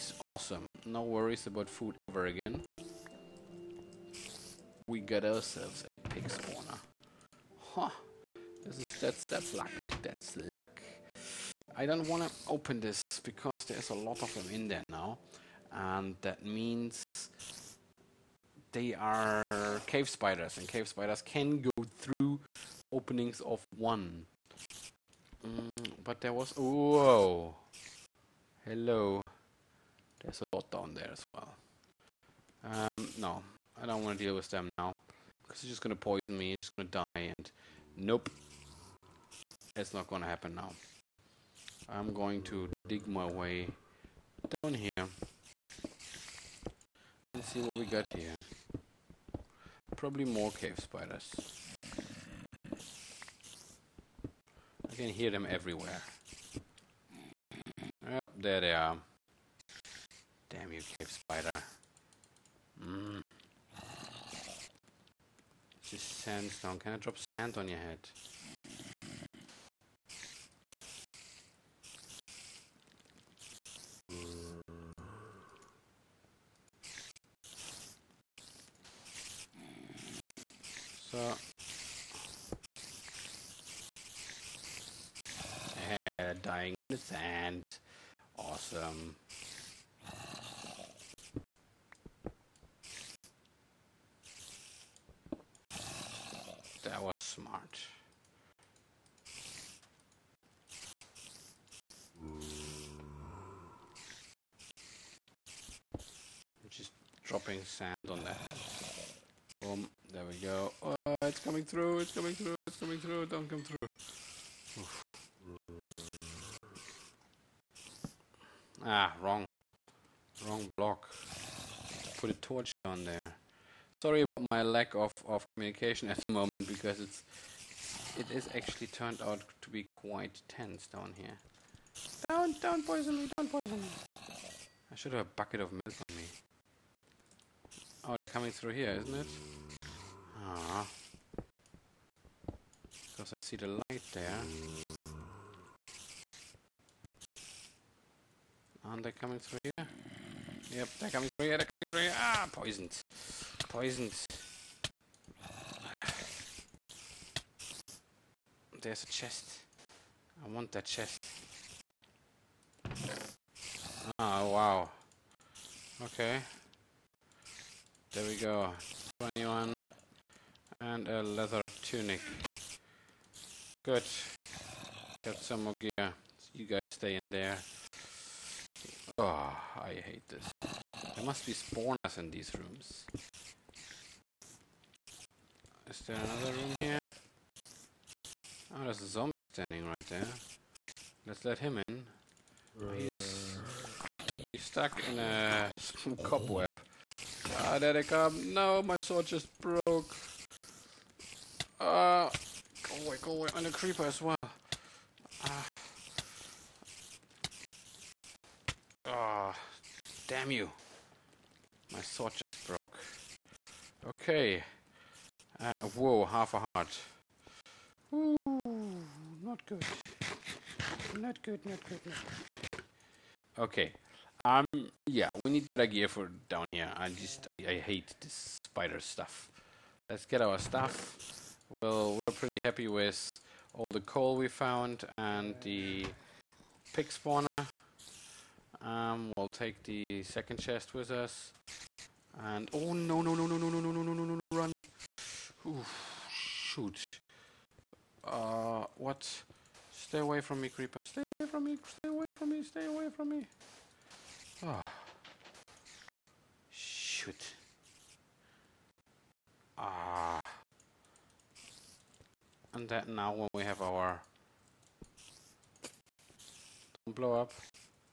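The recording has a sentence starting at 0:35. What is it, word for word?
Because it's just going to poison me, it's just going to die, and...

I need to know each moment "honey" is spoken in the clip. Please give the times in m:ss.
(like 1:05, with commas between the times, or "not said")
not said.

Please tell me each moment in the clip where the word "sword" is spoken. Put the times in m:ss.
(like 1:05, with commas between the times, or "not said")
3:19, 3:32.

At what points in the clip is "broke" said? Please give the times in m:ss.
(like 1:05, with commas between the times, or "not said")
3:19, 3:32.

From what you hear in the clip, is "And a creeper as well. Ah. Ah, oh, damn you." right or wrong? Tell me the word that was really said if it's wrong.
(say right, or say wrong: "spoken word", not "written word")
right.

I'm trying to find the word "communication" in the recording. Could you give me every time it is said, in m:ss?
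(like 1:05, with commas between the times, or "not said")
2:05.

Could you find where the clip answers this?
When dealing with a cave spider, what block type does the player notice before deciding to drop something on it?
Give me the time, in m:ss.
1:06.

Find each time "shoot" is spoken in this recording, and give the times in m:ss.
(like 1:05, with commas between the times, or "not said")
4:06, 4:16.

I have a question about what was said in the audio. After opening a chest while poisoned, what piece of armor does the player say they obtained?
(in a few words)
leather tunic.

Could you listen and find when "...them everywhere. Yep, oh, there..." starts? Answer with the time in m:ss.
0:55.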